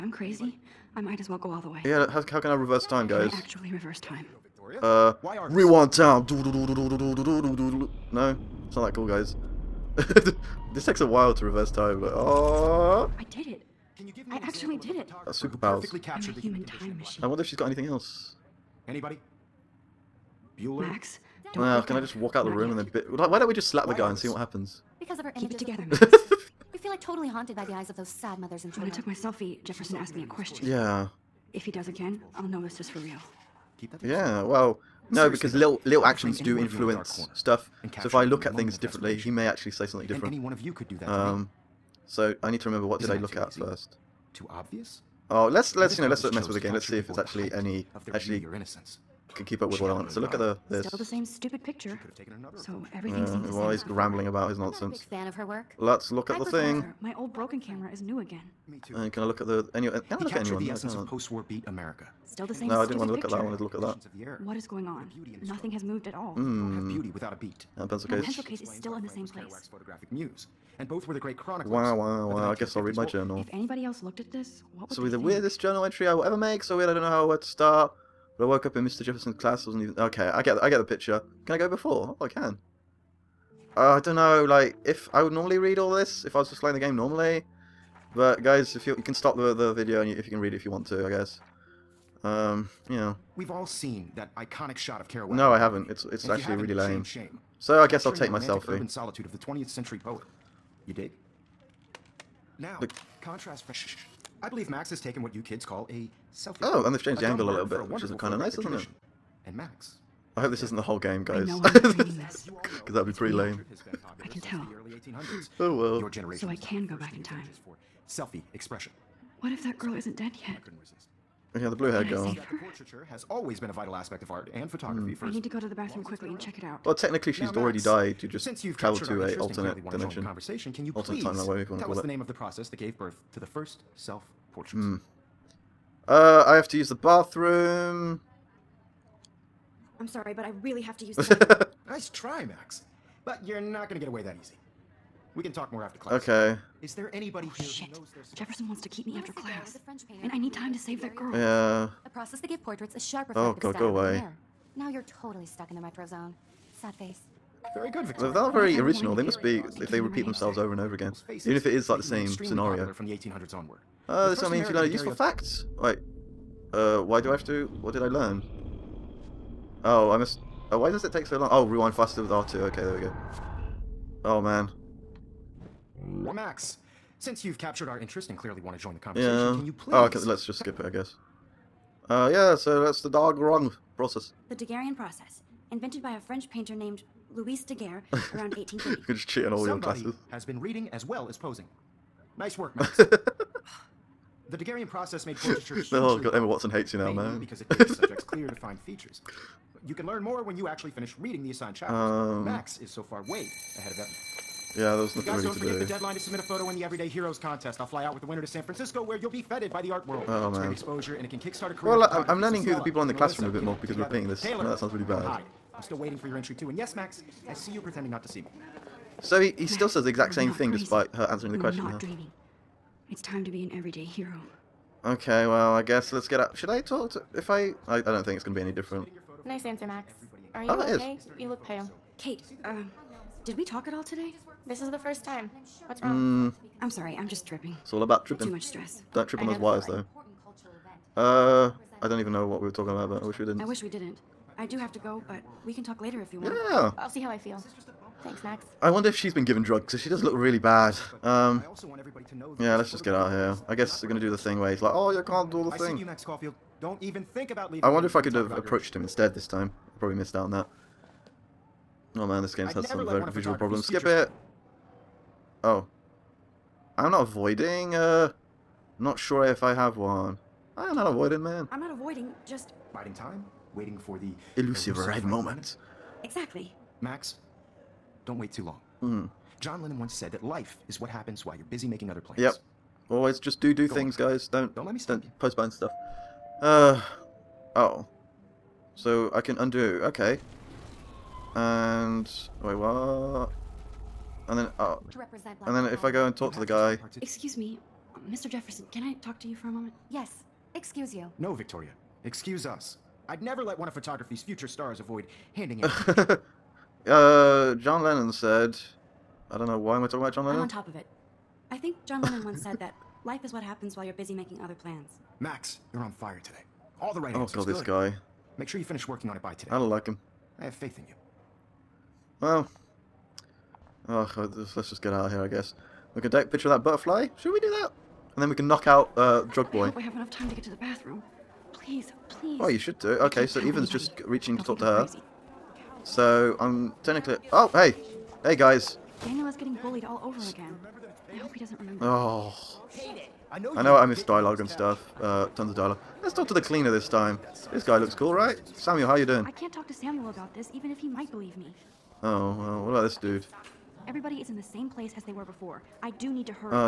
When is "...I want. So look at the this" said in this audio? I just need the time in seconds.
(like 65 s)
49 s.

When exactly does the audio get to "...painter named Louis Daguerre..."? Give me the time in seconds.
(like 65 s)
186 s.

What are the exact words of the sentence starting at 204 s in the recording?
Yeah, there was nothing guys don't forget the deadline to submit a photo in the Everyday Heroes contest.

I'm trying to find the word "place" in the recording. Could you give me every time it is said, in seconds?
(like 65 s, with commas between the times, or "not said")
69 s, 354 s.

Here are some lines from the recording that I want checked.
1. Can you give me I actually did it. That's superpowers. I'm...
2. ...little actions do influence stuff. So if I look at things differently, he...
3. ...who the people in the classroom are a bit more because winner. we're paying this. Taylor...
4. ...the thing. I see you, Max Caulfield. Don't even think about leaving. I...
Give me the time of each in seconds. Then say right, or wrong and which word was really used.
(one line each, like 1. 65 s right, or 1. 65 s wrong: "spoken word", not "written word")
1. 13 s right
2. 35 s right
3. 212 s wrong: "together", not "winner"
4. 255 s right.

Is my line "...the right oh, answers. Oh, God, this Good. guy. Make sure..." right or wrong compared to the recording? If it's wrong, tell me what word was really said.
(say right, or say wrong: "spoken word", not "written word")
right.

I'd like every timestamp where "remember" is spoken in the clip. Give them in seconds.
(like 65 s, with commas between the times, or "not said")
42 s, 341 s.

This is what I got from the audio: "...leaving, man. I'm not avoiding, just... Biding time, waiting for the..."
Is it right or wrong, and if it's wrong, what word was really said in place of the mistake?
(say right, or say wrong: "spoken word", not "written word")
wrong: "avoiding", not "leaving".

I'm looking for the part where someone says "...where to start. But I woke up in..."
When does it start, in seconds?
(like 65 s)
77 s.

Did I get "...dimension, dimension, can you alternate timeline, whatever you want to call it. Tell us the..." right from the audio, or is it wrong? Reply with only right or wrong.
wrong.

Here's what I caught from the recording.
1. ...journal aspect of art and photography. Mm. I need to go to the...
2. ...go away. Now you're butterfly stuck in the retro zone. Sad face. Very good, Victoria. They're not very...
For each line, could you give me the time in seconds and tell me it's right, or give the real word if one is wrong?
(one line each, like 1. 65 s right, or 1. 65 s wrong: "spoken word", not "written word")
1. 123 s wrong: "vital", not "journal"
2. 153 s wrong: "totally", not "butterfly".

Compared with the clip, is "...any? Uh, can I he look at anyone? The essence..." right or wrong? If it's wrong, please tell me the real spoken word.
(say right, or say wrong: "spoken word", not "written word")
right.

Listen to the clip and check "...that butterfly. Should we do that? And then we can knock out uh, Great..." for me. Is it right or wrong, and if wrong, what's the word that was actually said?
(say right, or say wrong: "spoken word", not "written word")
wrong: "Drug", not "Great".